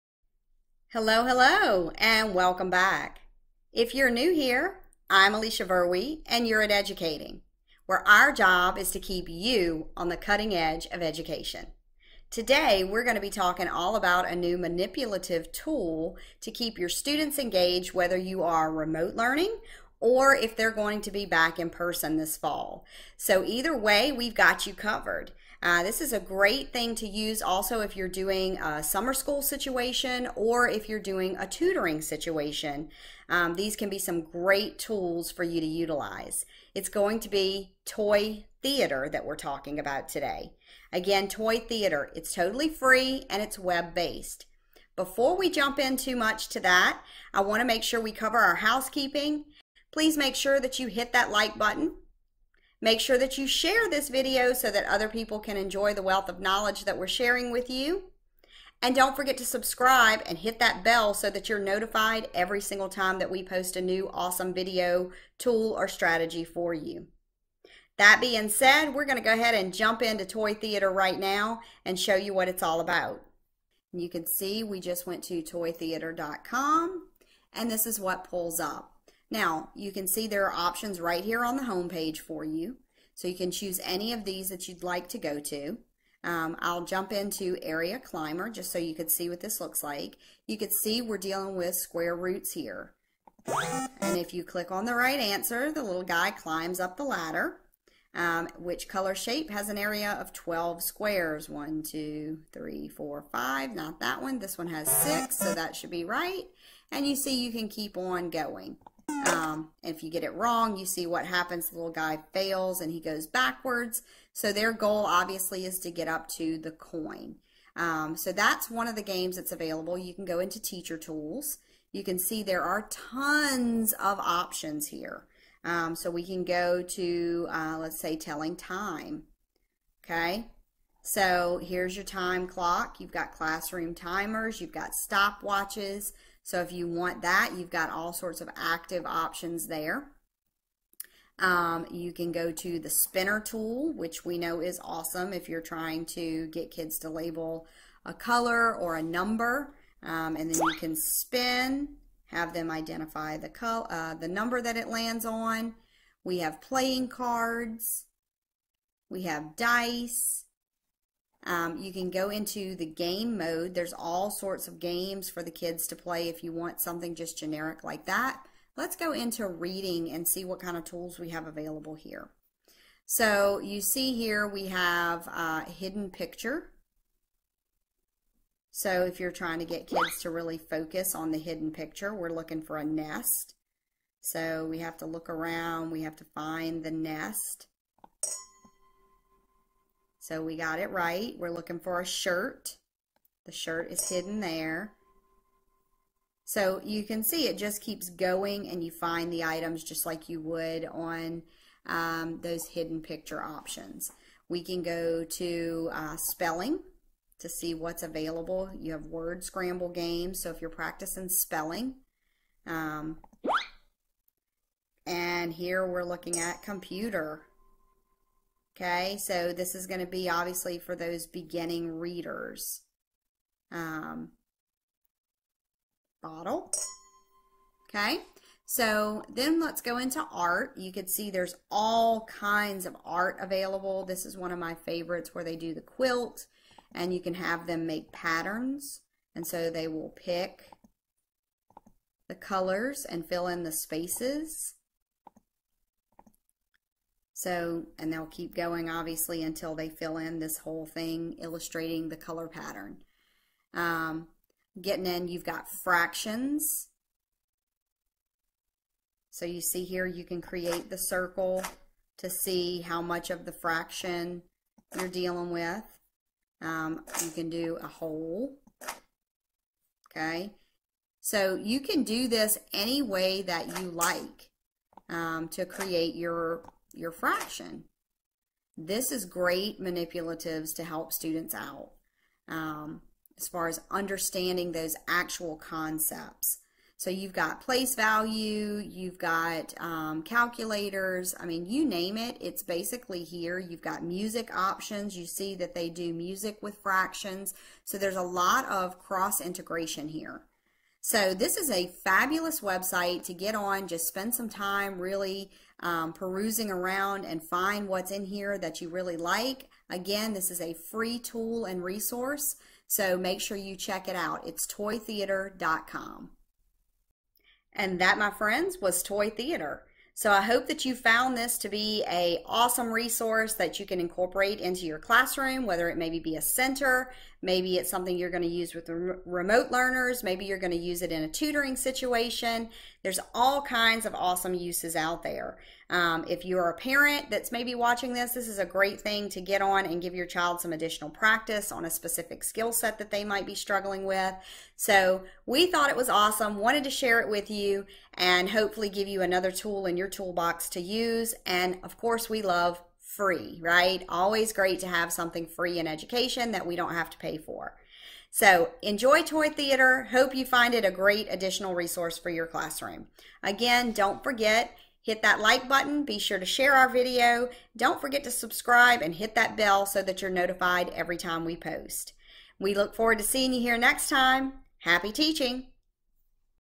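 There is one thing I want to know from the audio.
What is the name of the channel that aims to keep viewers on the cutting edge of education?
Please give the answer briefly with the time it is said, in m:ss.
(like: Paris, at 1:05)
EDGEucating, at 0:06.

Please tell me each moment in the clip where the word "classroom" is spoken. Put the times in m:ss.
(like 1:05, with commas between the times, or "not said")
2:13, 5:24, 6:02.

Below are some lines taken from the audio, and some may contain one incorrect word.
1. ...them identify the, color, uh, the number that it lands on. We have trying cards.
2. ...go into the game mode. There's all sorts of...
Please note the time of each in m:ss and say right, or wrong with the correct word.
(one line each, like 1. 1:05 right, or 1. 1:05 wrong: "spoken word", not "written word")
1. 2:32 wrong: "playing", not "trying"
2. 2:42 right.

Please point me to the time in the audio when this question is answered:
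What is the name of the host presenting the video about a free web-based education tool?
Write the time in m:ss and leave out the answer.
0:05.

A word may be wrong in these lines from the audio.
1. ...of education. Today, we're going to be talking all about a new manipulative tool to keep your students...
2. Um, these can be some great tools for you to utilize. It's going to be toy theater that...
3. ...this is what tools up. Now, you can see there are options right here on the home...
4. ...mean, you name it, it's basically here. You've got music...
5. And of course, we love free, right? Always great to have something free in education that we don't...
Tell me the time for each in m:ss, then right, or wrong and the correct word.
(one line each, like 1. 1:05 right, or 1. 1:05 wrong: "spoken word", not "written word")
1. 0:10 right
2. 0:33 right
3. 1:17 wrong: "pulls", not "tools"
4. 4:51 right
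5. 5:51 right.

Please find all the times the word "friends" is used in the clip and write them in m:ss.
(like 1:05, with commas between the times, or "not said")
5:18.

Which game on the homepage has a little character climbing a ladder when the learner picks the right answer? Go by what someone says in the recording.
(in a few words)
Area Climber.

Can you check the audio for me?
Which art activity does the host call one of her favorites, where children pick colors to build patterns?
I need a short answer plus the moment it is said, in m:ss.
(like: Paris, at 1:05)
The quilt, at 3:55.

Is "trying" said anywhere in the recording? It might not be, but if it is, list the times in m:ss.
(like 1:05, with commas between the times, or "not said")
2:25, 2:59.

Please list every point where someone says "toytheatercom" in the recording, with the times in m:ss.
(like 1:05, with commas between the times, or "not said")
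1:15, 5:14.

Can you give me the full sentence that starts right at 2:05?
Um, so we can go to, uh, let's say, telling time.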